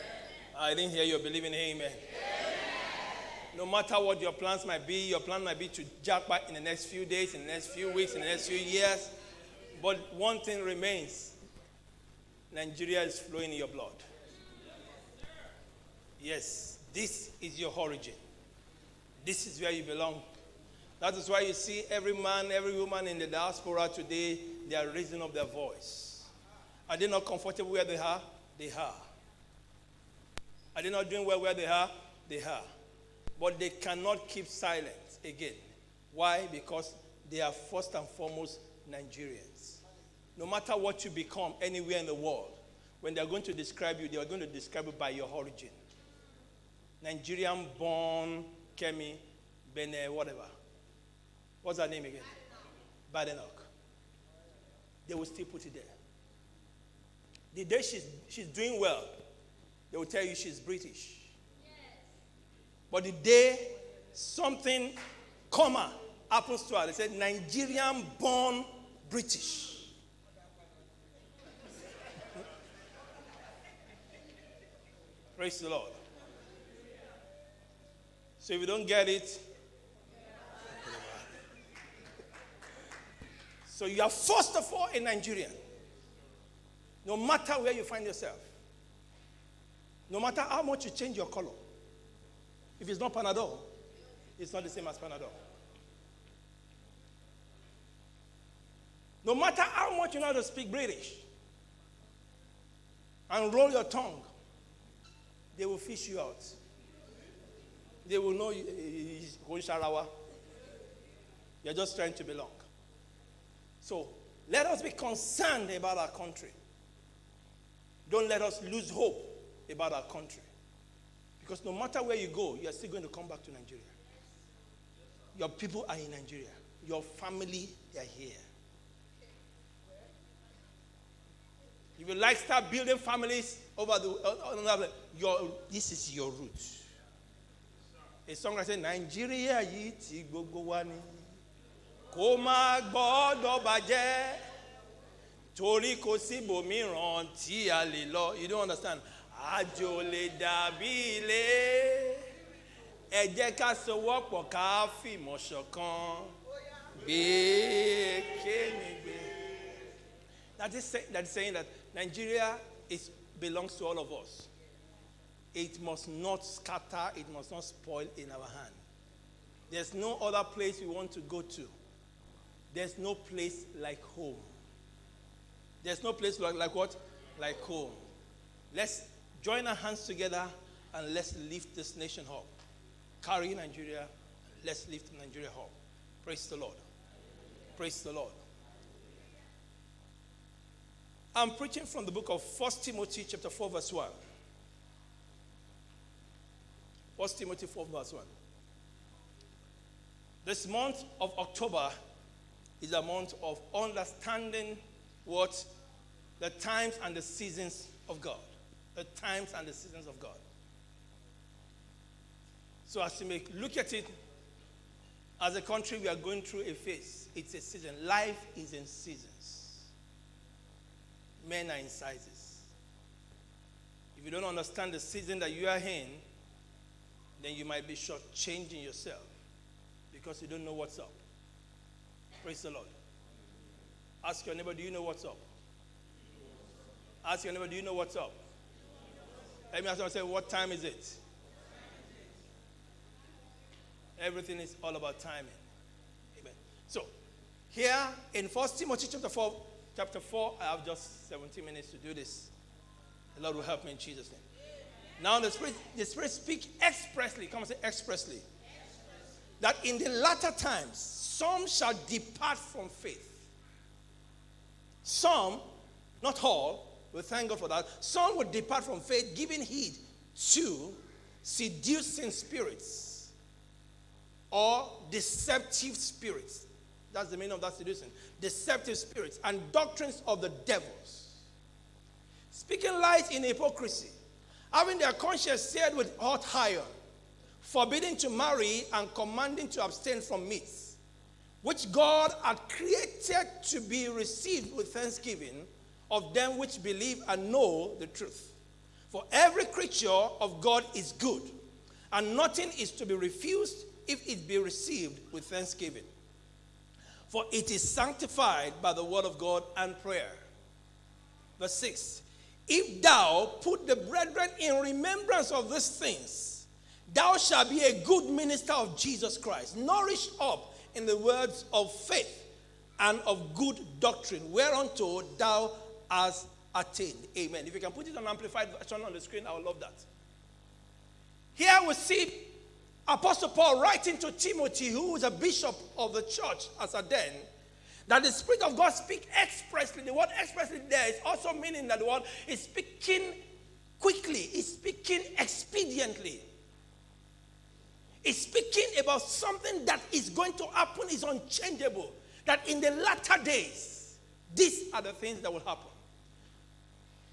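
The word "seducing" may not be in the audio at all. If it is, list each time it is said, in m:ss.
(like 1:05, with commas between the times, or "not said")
4:31, 4:37.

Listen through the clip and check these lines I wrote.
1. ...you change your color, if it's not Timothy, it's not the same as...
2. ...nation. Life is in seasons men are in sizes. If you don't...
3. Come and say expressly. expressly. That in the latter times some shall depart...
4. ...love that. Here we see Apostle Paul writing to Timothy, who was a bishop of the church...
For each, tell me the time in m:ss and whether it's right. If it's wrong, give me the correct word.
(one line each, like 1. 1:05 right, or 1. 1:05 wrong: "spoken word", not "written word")
1. 1:30 wrong: "Panadol", not "Timothy"
2. 3:37 wrong: "season", not "nation"
3. 4:17 right
4. 5:29 right.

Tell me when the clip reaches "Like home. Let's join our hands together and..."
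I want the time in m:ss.
2:57.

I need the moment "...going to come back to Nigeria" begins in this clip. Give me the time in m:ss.
2:02.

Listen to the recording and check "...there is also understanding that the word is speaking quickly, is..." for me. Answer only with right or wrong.
wrong.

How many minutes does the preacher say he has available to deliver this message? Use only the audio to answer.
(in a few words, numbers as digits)
17.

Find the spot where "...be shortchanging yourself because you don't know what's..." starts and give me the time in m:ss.
3:47.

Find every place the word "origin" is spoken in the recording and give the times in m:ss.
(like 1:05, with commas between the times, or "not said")
0:17, 0:45.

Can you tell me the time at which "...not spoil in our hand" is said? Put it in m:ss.
2:47.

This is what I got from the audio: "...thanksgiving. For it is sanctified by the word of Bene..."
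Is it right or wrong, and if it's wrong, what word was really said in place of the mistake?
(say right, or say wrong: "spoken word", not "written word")
wrong: "God", not "Bene".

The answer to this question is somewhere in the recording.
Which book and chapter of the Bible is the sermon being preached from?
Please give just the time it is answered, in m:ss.
3:12.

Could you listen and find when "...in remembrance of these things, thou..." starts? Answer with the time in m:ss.
5:14.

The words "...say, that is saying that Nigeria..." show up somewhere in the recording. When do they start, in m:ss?
2:40.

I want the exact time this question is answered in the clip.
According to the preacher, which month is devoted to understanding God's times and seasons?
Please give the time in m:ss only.
3:21.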